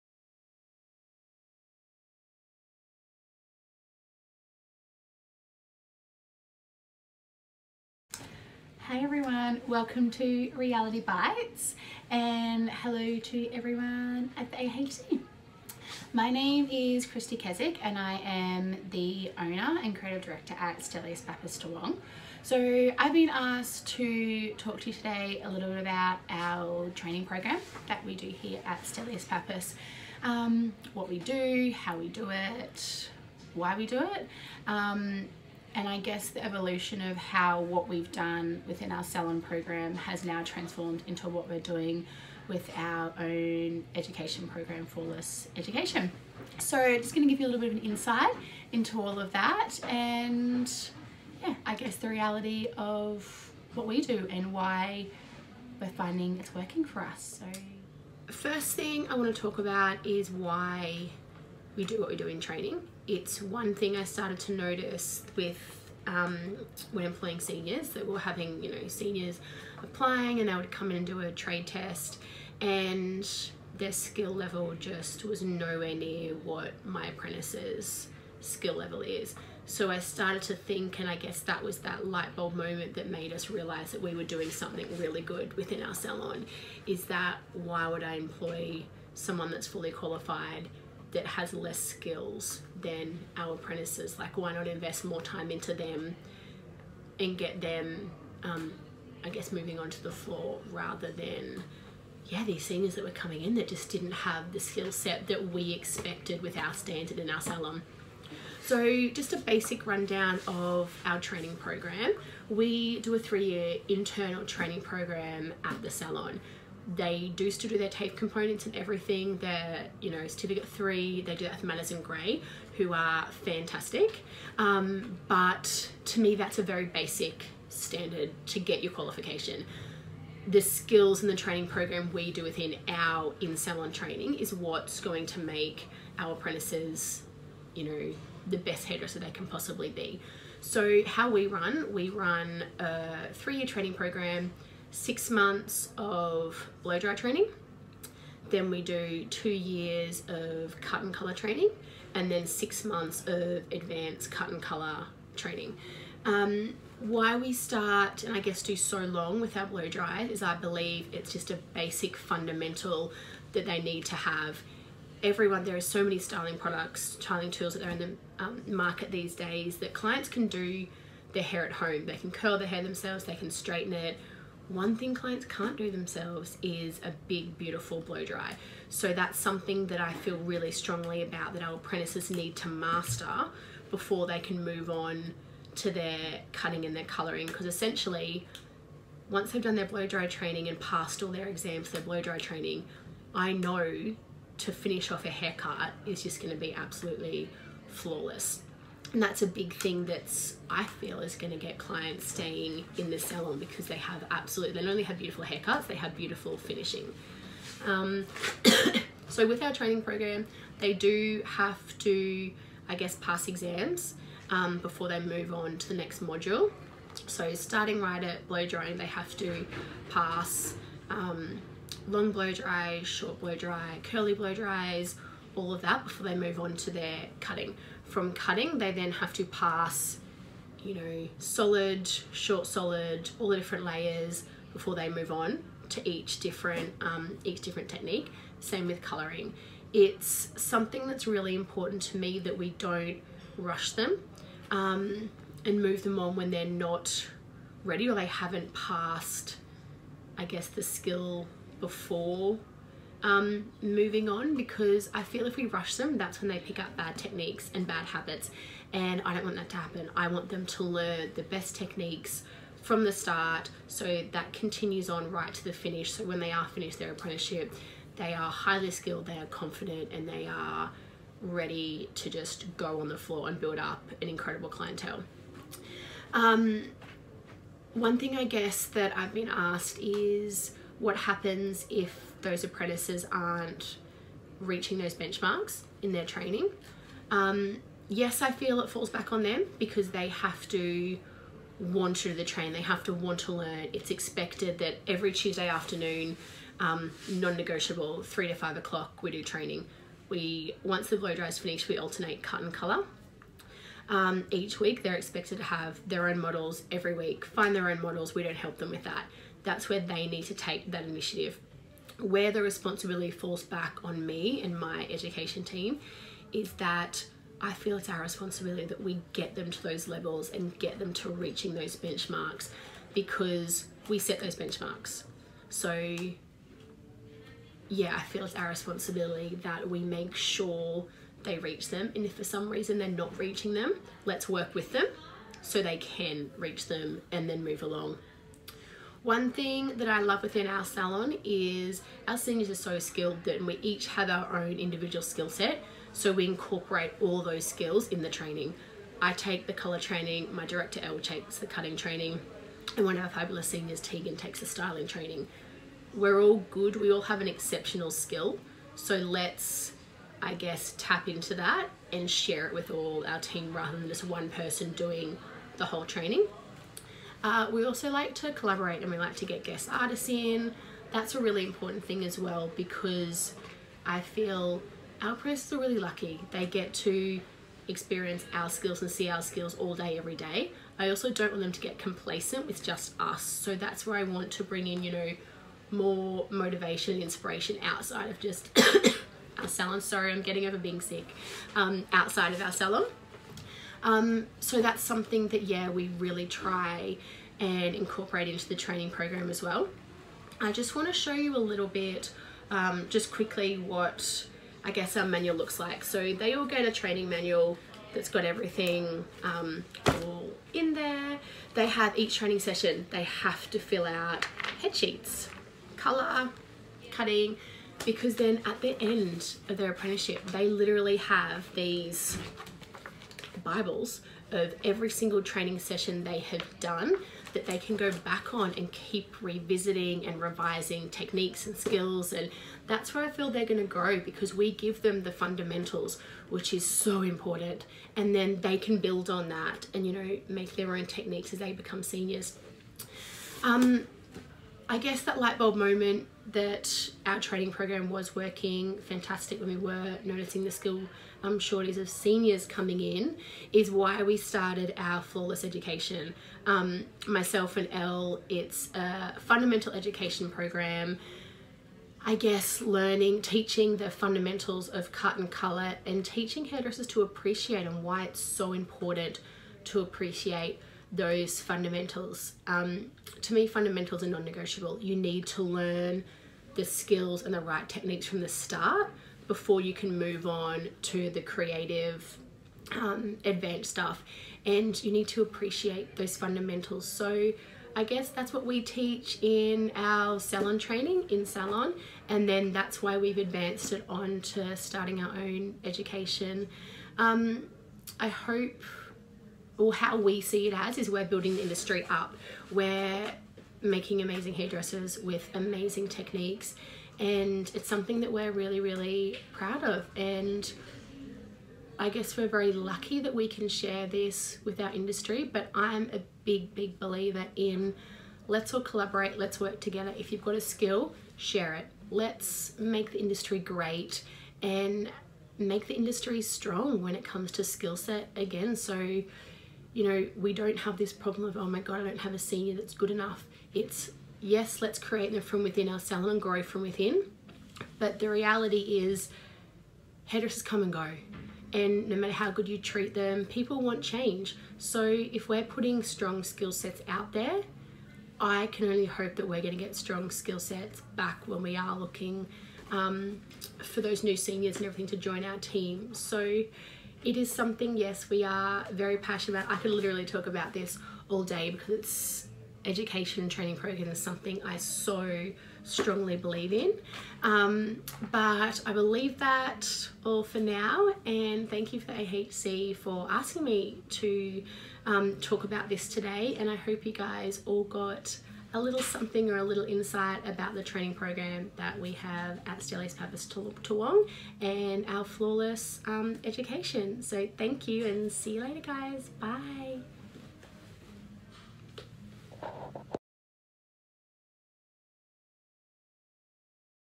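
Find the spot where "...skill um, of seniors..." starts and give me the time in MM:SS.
07:30.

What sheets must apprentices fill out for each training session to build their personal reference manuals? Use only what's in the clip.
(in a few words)
Head sheets.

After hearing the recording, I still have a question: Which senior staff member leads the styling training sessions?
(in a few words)
Tegan.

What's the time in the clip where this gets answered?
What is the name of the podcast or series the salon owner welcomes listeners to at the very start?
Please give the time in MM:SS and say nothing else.
00:10.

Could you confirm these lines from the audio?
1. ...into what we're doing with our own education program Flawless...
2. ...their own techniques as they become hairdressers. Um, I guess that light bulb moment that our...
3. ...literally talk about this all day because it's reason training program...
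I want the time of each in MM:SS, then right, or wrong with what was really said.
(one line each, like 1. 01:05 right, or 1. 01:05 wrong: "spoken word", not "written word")
1. 00:41 right
2. 07:20 wrong: "seniors", not "hairdressers"
3. 09:19 wrong: "education", not "reason".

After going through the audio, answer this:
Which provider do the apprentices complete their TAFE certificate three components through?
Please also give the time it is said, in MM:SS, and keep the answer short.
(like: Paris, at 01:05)
Manners and Gray, at 02:01.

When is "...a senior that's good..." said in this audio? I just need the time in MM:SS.
08:52.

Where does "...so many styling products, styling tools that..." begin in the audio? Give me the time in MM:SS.
02:45.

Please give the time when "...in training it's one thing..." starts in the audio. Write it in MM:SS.
01:02.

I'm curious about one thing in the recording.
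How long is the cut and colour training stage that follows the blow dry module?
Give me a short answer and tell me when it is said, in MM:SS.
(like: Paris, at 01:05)
2 years, at 02:29.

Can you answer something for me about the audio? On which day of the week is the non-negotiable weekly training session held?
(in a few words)
Tuesday.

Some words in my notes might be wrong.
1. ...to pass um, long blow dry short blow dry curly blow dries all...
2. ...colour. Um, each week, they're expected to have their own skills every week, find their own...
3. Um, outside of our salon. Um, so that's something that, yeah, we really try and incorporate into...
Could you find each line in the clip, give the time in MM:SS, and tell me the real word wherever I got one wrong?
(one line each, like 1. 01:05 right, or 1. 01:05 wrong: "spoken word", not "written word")
1. 03:39 right
2. 05:02 wrong: "models", not "skills"
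3. 06:31 right.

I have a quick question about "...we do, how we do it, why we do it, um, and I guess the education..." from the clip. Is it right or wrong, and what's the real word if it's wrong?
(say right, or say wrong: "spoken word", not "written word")
wrong: "evolution", not "education".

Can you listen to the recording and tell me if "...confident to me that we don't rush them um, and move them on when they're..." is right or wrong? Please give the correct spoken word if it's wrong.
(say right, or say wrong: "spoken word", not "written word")
wrong: "important", not "confident".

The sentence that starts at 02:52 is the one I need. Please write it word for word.
They can curl their hair themselves, they can straighten it, one thing clients can't do themselves is a big, beautiful blow dry.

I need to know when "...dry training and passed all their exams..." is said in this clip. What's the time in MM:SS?
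03:10.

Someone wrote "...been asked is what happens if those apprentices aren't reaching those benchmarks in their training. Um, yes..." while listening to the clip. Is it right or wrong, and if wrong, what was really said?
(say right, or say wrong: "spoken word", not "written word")
right.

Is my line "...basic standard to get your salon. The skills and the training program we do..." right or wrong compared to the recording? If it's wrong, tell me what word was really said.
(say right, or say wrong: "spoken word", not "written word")
wrong: "qualification", not "salon".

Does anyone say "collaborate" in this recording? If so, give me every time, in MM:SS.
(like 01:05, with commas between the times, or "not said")
06:08, 08:38.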